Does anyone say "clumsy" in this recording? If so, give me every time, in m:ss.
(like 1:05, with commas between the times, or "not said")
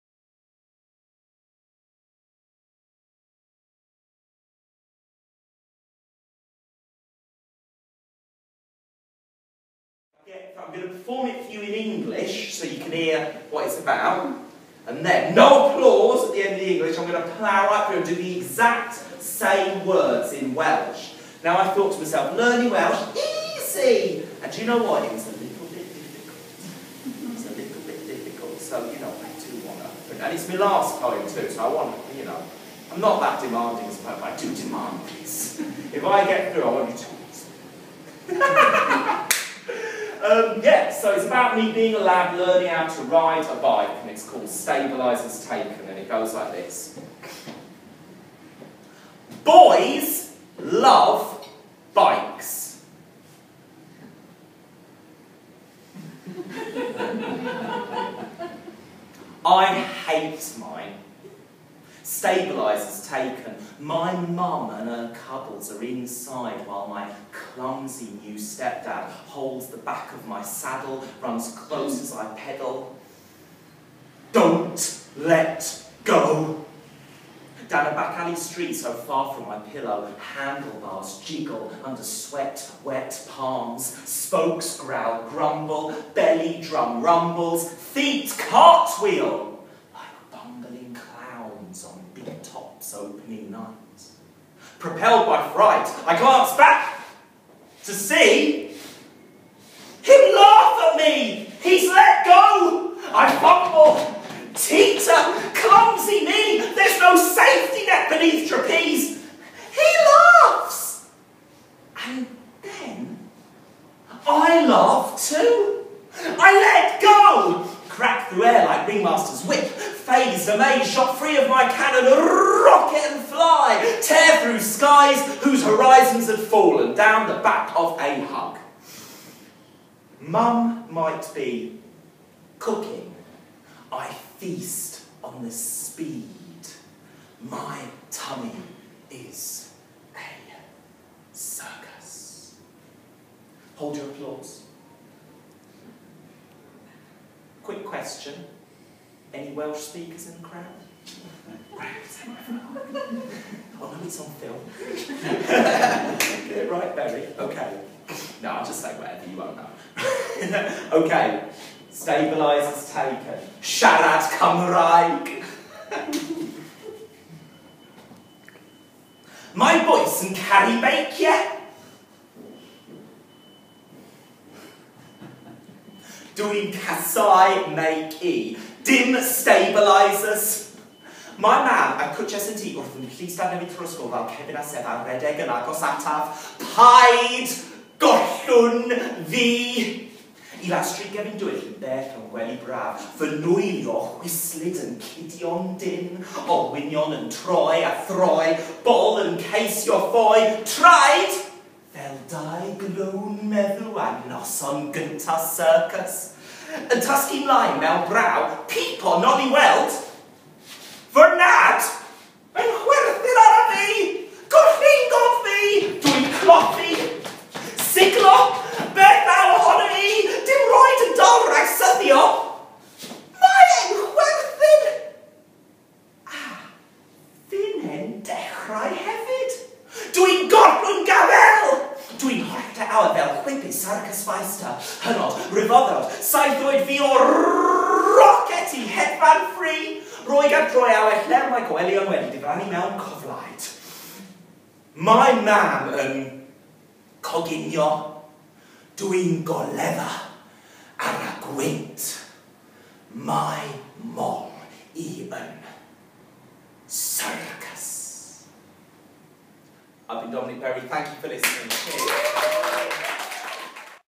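1:07, 1:45.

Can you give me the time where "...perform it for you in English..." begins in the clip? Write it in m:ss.
0:10.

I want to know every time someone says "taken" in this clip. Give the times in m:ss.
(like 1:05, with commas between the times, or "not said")
0:45, 1:03, 2:42.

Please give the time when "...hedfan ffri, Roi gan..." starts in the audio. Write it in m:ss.
3:58.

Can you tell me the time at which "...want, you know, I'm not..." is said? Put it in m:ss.
0:31.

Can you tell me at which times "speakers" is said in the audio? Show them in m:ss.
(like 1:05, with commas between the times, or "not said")
2:29.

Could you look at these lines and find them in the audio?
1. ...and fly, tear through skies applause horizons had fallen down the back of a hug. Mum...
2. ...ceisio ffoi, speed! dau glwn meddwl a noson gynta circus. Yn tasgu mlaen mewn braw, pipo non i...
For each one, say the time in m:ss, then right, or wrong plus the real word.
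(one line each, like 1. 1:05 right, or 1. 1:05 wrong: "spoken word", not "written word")
1. 2:02 wrong: "whose", not "applause"
2. 3:19 wrong: "traed", not "speed".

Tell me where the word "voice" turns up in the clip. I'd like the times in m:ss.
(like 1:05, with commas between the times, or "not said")
2:49.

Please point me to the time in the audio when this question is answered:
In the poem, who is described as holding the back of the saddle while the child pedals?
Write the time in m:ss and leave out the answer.
1:08.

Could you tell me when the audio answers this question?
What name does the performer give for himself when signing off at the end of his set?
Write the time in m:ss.
4:20.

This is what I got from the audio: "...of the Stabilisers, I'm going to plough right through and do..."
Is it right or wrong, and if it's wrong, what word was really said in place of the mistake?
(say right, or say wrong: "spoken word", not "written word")
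wrong: "English", not "Stabilisers".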